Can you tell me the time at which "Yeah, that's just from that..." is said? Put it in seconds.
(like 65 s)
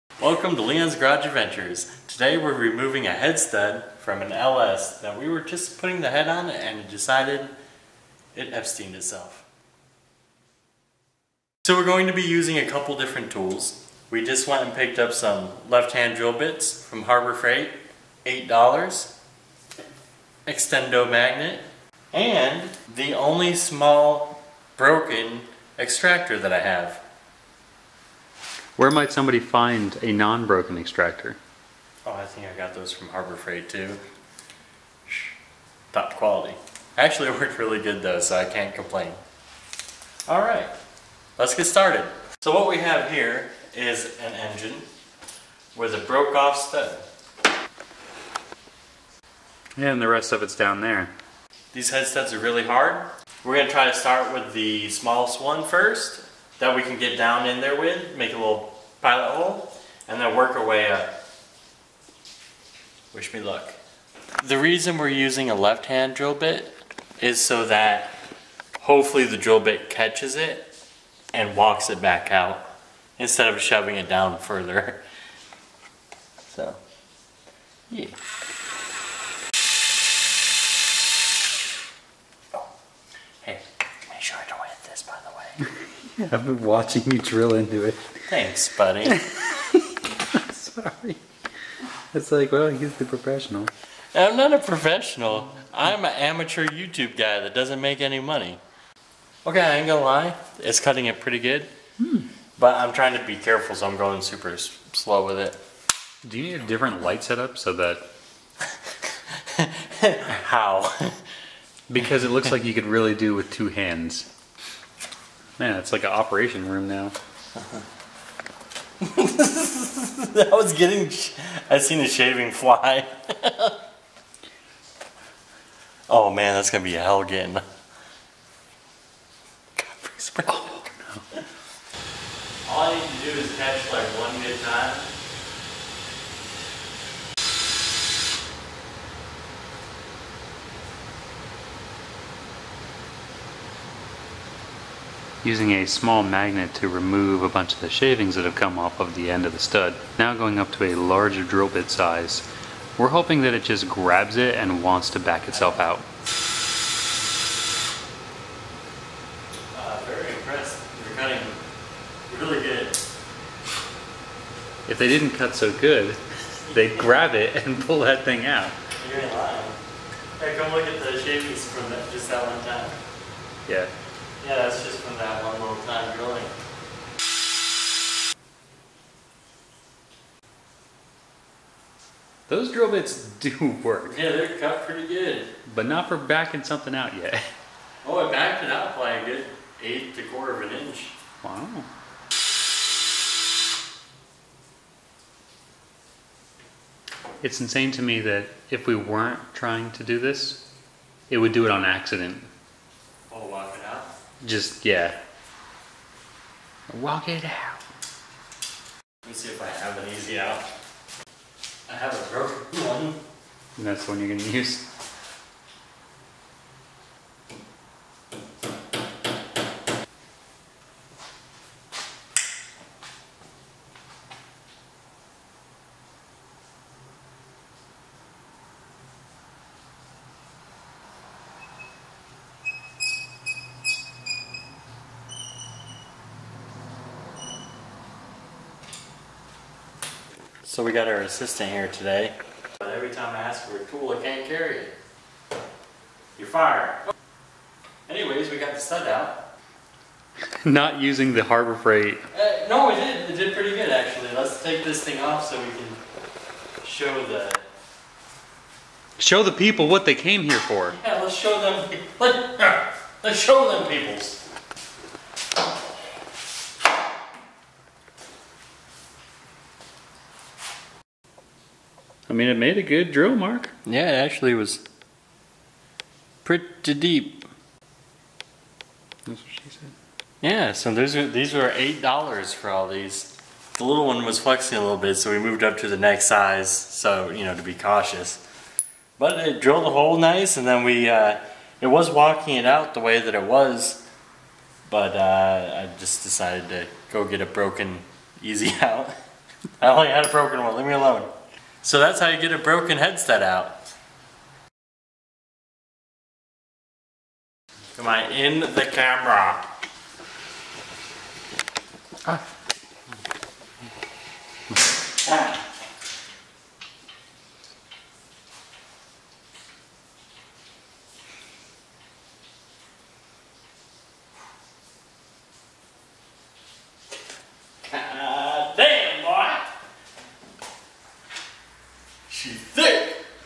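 174 s.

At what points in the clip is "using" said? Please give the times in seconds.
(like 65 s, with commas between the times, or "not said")
12 s, 65 s, 145 s, 251 s.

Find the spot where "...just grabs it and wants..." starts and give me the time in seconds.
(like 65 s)
153 s.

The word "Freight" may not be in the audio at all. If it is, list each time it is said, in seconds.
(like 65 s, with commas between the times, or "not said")
17 s, 33 s, 251 s.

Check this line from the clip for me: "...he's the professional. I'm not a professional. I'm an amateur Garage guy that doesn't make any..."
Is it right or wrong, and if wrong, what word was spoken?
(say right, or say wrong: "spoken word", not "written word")
wrong: "YouTube", not "Garage".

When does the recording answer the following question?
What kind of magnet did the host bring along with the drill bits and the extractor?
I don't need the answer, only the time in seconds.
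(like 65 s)
20 s.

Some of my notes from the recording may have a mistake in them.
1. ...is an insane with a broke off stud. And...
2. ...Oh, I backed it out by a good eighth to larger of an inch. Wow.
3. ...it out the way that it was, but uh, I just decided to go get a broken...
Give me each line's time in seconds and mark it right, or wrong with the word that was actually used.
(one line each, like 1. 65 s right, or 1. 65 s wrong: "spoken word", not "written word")
1. 43 s wrong: "engine", not "insane"
2. 188 s wrong: "quarter", not "larger"
3. 292 s right.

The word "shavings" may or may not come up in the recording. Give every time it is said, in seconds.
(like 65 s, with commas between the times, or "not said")
122 s, 147 s, 171 s.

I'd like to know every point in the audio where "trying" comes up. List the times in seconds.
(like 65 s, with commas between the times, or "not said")
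102 s, 199 s.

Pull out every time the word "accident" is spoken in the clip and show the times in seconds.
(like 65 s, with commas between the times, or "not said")
201 s.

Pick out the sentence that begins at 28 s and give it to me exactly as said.
Where might somebody find a non-broken extractor?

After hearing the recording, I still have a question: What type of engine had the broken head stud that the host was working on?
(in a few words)
LS.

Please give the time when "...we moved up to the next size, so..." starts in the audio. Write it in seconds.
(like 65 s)
285 s.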